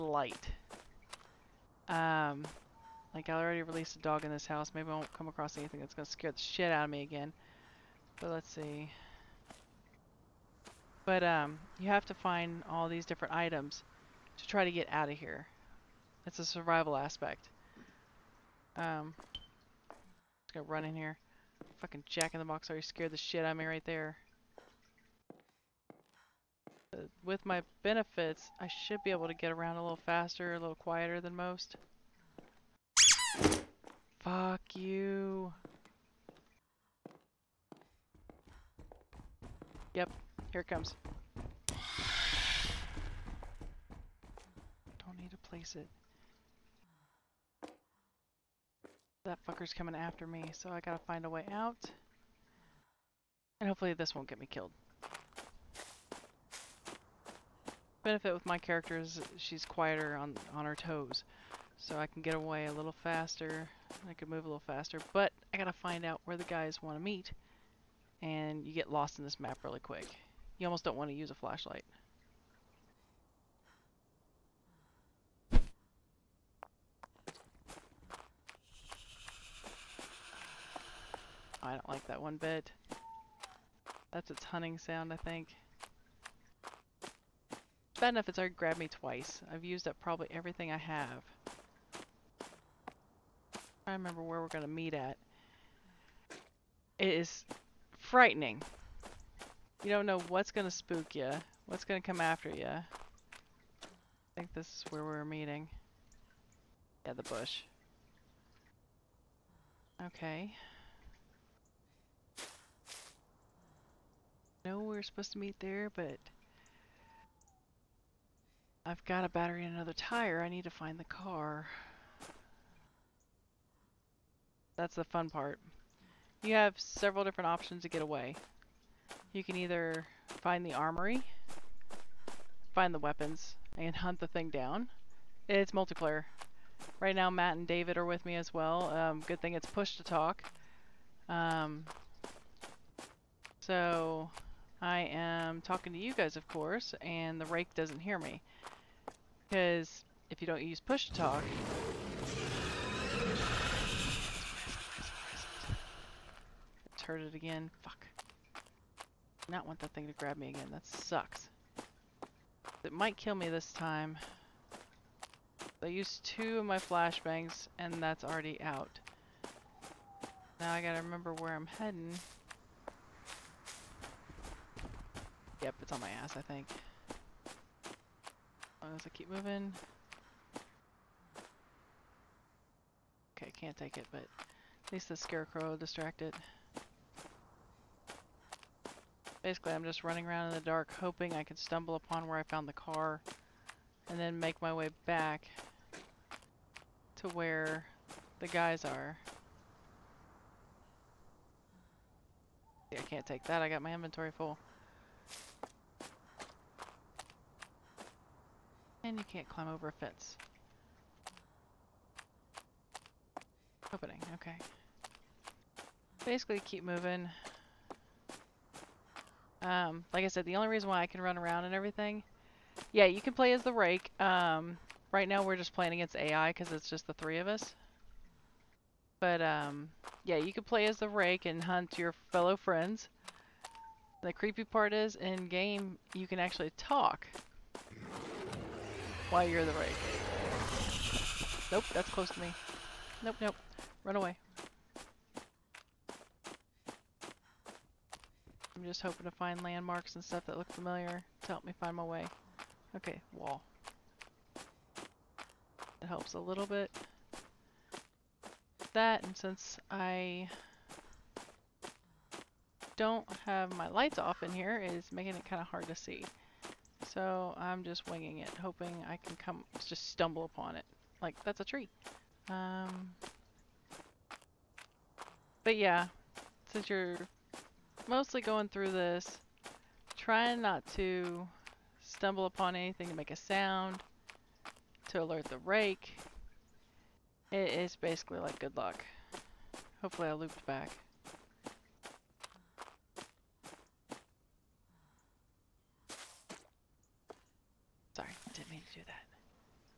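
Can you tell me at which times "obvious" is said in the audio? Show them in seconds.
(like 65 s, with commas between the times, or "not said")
not said.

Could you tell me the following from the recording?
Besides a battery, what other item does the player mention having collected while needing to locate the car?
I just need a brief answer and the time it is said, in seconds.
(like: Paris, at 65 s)
tire, at 119 s.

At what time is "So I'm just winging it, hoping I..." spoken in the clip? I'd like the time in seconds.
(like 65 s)
267 s.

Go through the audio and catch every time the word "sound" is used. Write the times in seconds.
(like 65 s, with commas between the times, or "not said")
84 s, 283 s.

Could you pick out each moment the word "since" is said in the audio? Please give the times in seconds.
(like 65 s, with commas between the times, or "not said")
259 s, 276 s.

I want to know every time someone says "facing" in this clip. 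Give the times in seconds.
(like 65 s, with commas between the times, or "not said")
not said.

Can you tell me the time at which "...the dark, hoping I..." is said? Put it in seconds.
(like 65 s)
190 s.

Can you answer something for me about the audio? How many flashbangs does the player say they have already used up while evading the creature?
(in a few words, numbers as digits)
2.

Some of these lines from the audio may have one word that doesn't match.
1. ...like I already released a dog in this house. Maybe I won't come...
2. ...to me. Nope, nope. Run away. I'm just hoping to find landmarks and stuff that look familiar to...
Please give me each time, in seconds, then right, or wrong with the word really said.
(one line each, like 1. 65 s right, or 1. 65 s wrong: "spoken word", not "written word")
1. 3 s right
2. 242 s right.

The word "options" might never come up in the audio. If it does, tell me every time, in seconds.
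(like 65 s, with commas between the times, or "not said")
127 s.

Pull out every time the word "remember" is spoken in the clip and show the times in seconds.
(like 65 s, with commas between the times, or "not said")
93 s, 171 s.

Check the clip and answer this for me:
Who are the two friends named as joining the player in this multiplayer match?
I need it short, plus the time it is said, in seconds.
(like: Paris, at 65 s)
Matt and David, at 137 s.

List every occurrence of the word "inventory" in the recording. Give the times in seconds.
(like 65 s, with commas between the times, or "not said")
203 s.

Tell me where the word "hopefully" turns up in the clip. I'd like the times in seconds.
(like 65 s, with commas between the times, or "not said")
53 s, 289 s.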